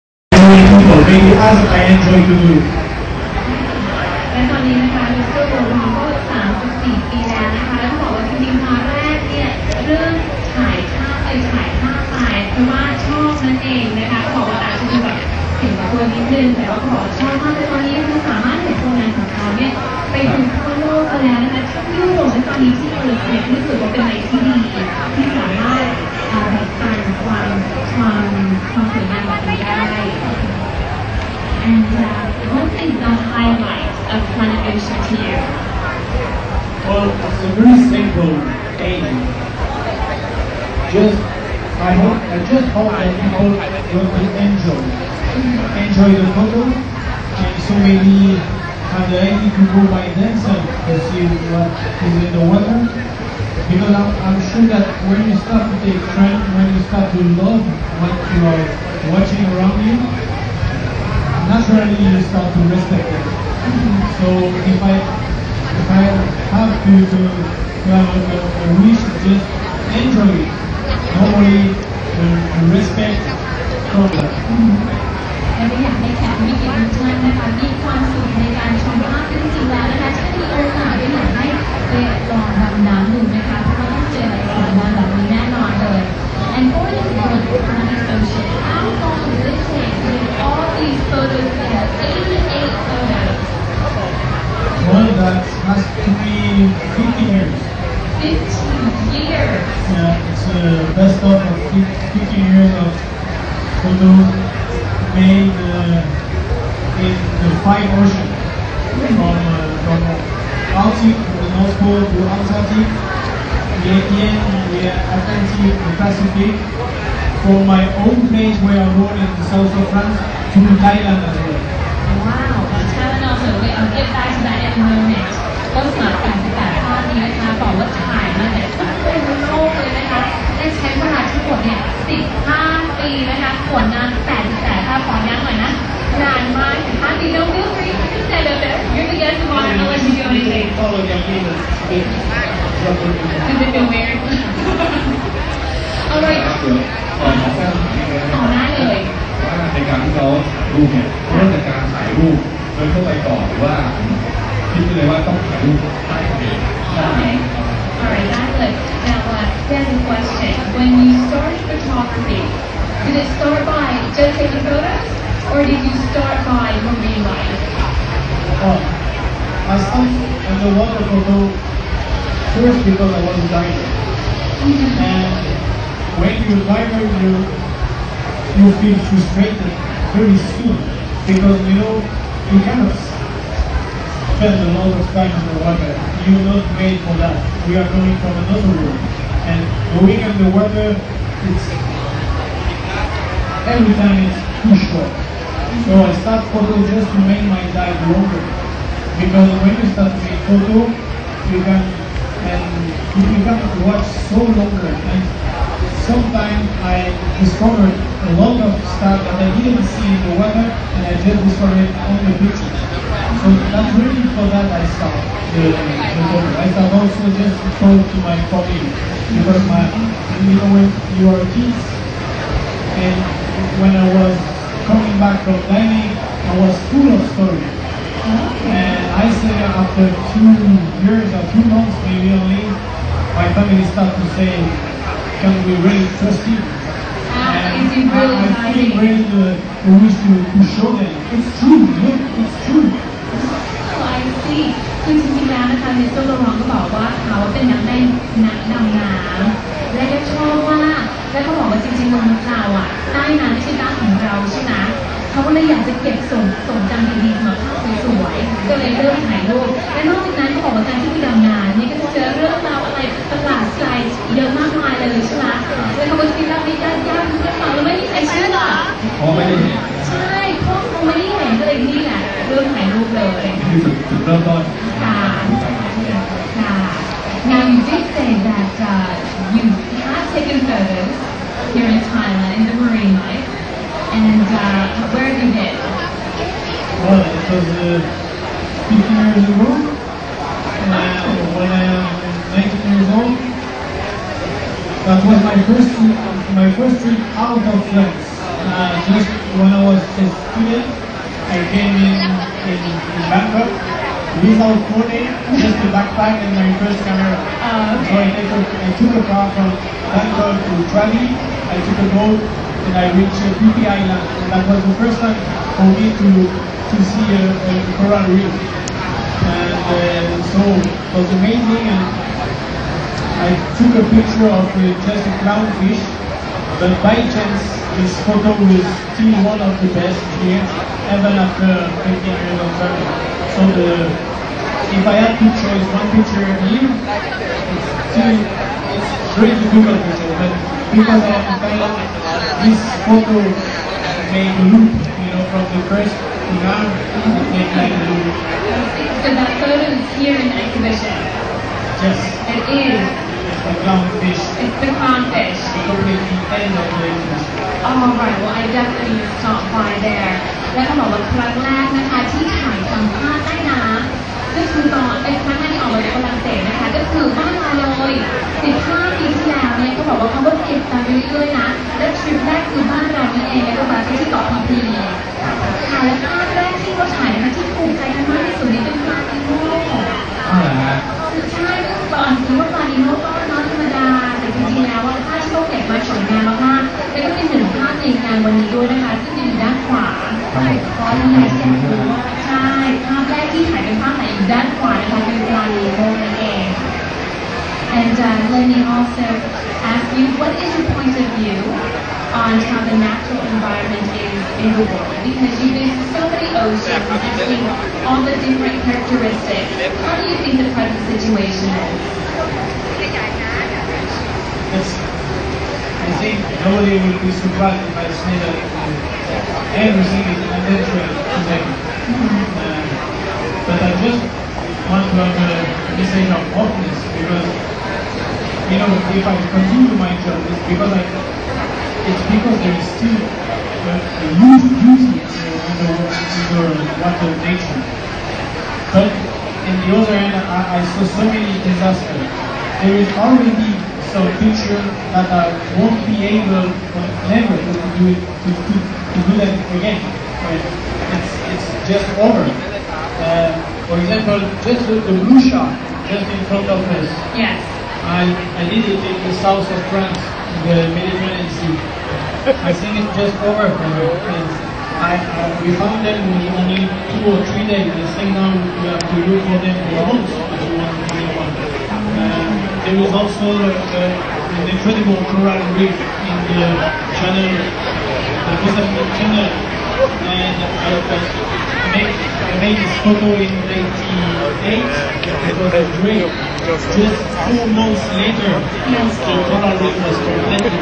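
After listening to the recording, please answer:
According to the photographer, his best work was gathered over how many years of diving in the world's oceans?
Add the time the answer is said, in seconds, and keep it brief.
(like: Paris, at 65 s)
15 years, at 100 s.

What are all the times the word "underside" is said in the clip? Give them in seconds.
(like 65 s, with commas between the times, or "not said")
not said.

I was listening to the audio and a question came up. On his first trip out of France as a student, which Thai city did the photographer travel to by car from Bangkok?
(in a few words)
Krabi.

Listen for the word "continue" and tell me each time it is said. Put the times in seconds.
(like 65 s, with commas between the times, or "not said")
429 s.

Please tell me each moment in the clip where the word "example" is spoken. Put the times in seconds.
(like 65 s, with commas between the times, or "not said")
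453 s.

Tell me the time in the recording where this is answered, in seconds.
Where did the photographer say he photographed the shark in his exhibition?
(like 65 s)
460 s.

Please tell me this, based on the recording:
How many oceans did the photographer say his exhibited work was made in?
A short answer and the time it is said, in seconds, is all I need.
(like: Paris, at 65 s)
5, at 107 s.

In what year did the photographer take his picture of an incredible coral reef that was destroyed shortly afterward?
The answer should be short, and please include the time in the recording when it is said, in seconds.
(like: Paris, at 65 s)
1988, at 483 s.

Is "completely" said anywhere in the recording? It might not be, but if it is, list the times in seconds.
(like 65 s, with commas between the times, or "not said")
355 s, 490 s.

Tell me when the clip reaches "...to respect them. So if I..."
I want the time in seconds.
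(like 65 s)
62 s.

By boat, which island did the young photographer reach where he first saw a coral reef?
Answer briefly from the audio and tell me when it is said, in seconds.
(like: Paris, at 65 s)
Phi Island, at 313 s.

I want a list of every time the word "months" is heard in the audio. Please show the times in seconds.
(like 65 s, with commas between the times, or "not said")
231 s, 470 s, 487 s.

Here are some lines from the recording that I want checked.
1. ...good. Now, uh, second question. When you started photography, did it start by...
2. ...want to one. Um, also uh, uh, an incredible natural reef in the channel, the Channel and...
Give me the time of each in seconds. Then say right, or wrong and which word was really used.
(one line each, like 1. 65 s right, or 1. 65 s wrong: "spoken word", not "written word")
1. 158 s right
2. 470 s wrong: "coral", not "natural".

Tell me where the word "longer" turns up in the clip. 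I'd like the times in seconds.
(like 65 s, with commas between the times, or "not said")
198 s, 204 s.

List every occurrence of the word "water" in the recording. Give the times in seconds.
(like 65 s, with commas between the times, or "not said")
52 s, 170 s, 185 s, 190 s, 437 s.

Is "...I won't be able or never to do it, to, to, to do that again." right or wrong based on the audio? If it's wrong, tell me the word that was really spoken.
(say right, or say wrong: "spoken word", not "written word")
right.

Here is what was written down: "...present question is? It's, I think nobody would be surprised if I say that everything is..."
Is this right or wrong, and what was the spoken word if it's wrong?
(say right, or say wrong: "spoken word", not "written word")
wrong: "situation", not "question".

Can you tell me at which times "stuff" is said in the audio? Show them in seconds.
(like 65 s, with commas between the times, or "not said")
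208 s.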